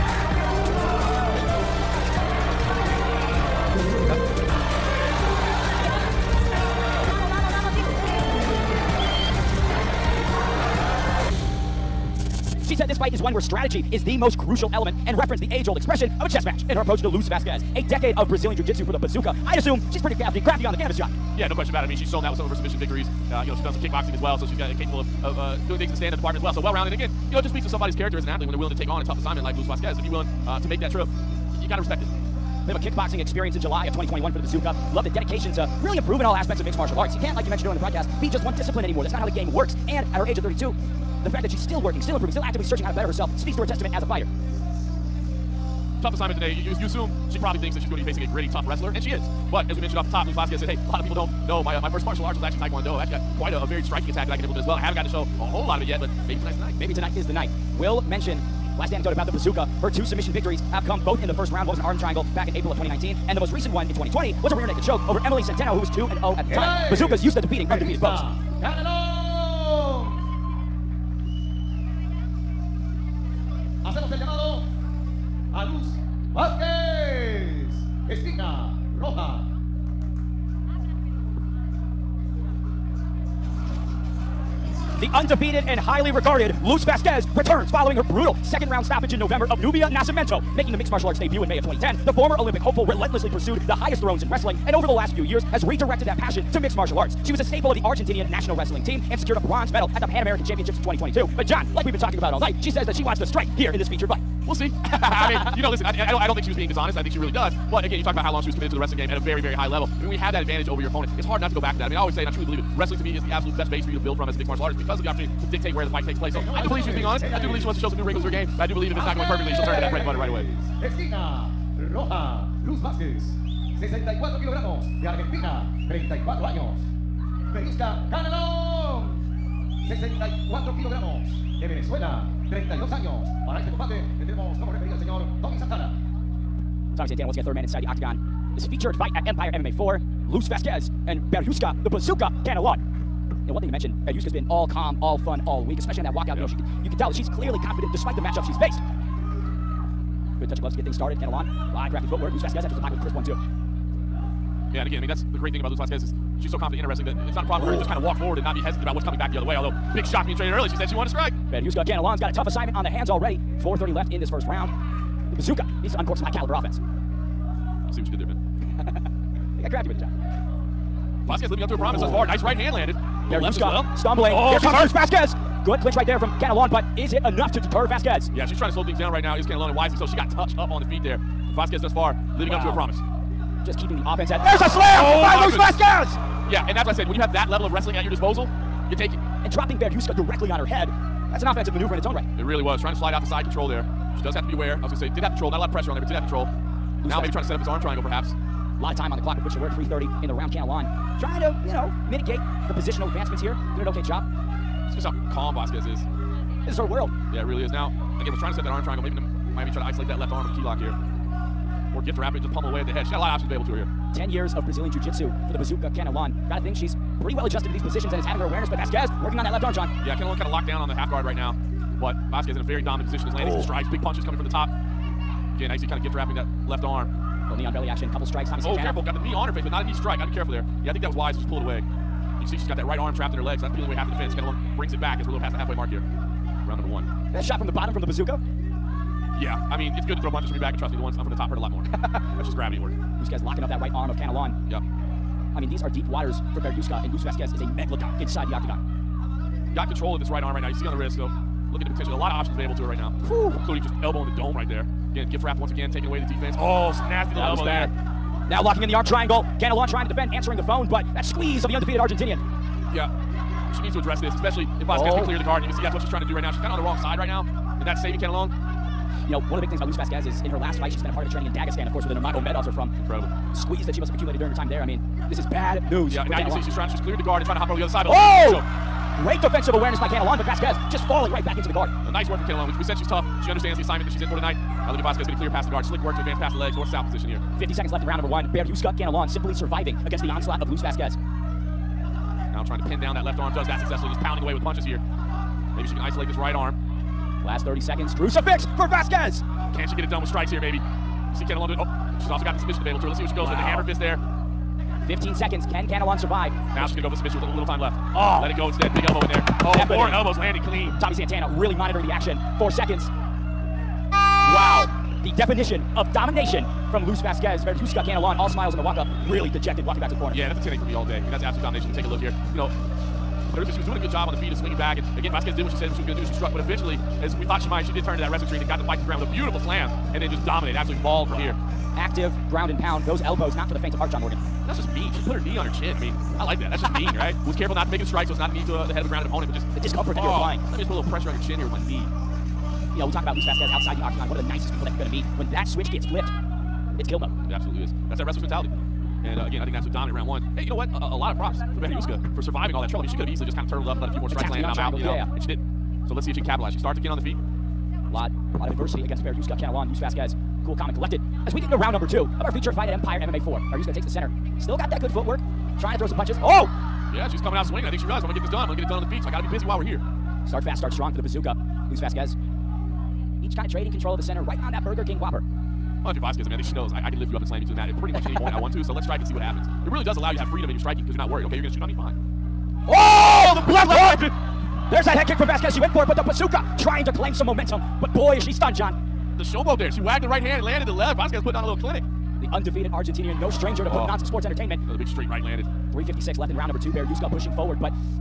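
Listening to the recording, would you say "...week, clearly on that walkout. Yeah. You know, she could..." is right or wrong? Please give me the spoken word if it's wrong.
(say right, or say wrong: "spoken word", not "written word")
wrong: "especially", not "clearly".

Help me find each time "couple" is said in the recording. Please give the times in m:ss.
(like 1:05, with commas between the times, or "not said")
3:48.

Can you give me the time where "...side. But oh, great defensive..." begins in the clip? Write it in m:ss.
4:37.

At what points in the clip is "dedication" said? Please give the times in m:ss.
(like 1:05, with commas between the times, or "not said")
0:35.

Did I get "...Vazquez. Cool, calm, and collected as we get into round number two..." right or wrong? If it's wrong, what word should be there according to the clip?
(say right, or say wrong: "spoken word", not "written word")
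right.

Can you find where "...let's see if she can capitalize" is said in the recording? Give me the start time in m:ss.
5:56.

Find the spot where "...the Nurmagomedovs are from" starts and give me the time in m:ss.
4:32.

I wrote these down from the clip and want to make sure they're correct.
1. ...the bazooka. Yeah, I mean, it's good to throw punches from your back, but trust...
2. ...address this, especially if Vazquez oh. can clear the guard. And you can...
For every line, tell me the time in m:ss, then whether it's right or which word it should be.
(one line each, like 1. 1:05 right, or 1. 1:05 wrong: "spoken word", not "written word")
1. 3:58 right
2. 4:23 right.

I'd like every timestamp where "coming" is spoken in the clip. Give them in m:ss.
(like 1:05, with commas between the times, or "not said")
2:39, 3:44, 6:07.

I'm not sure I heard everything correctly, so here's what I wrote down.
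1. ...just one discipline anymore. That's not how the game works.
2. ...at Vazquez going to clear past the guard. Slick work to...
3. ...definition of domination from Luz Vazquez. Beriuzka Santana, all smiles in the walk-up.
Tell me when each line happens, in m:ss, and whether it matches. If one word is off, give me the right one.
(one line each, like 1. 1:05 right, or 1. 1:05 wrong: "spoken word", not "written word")
1. 0:38 right
2. 4:44 right
3. 5:15 wrong: "Canelon", not "Santana".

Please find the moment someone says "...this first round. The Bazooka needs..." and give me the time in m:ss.
2:44.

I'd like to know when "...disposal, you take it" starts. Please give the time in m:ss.
3:08.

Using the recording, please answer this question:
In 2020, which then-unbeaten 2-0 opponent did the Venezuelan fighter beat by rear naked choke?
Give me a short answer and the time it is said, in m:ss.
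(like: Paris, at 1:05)
Emily Centeno, at 1:05.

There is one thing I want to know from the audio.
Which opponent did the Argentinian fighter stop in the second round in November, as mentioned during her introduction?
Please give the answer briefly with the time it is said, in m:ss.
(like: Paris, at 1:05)
Nubia Nascimento, at 1:29.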